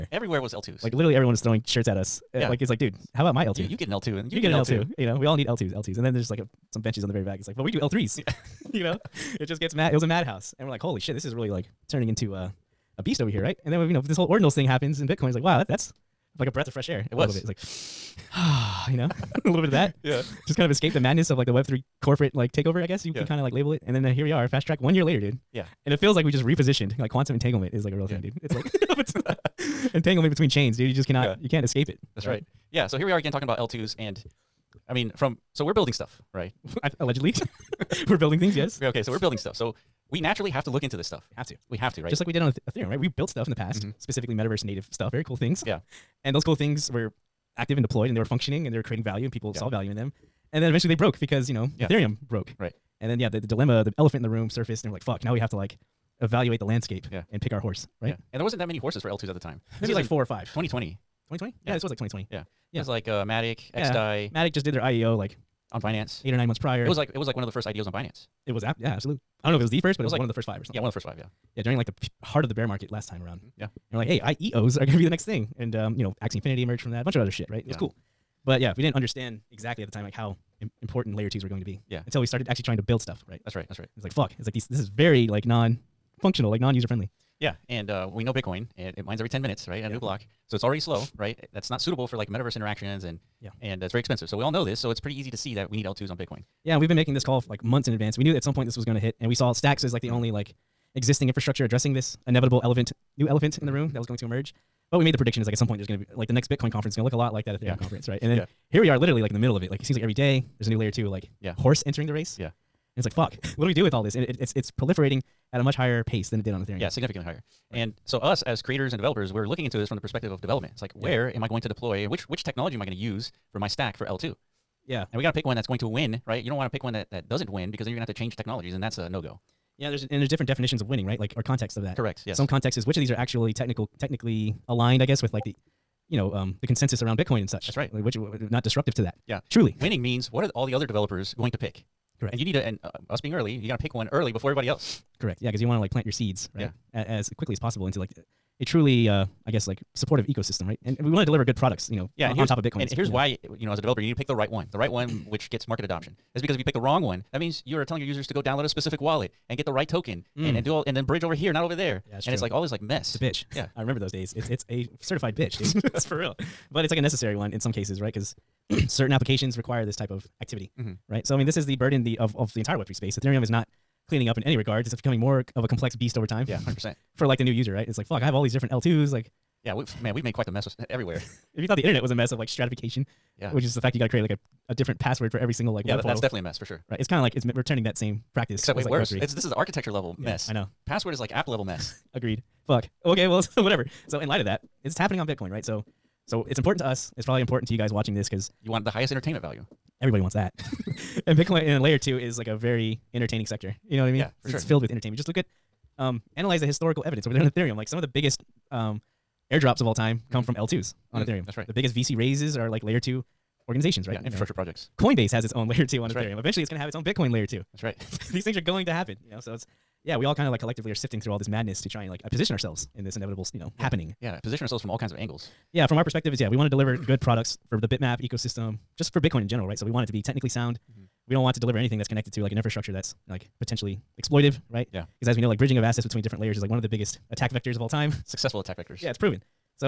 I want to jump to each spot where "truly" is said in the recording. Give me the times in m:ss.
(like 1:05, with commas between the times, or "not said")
2:19, 2:28.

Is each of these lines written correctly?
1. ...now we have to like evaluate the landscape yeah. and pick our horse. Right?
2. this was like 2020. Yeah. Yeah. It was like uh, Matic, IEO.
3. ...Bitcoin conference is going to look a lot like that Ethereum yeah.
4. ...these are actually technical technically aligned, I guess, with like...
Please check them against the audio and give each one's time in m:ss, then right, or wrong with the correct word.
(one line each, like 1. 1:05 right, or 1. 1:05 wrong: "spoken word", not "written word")
1. 0:55 right
2. 1:01 wrong: "Yeah", not "IEO"
3. 1:46 right
4. 2:13 right.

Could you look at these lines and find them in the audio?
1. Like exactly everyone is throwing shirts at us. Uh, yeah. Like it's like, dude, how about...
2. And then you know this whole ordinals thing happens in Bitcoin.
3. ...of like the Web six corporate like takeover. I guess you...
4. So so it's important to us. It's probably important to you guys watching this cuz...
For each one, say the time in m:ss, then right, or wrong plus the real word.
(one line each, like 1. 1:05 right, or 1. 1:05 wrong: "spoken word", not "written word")
1. 0:00 wrong: "literally", not "exactly"
2. 0:13 right
3. 0:21 wrong: "three", not "six"
4. 3:15 right.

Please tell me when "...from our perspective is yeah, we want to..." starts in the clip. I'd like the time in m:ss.
3:45.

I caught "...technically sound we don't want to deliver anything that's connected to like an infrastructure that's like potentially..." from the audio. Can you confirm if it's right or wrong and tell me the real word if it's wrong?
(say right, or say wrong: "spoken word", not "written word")
right.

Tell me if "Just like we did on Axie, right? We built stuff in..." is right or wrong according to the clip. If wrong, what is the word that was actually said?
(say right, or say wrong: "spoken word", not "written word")
wrong: "Ethereum", not "Axie".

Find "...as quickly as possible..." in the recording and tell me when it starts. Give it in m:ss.
2:27.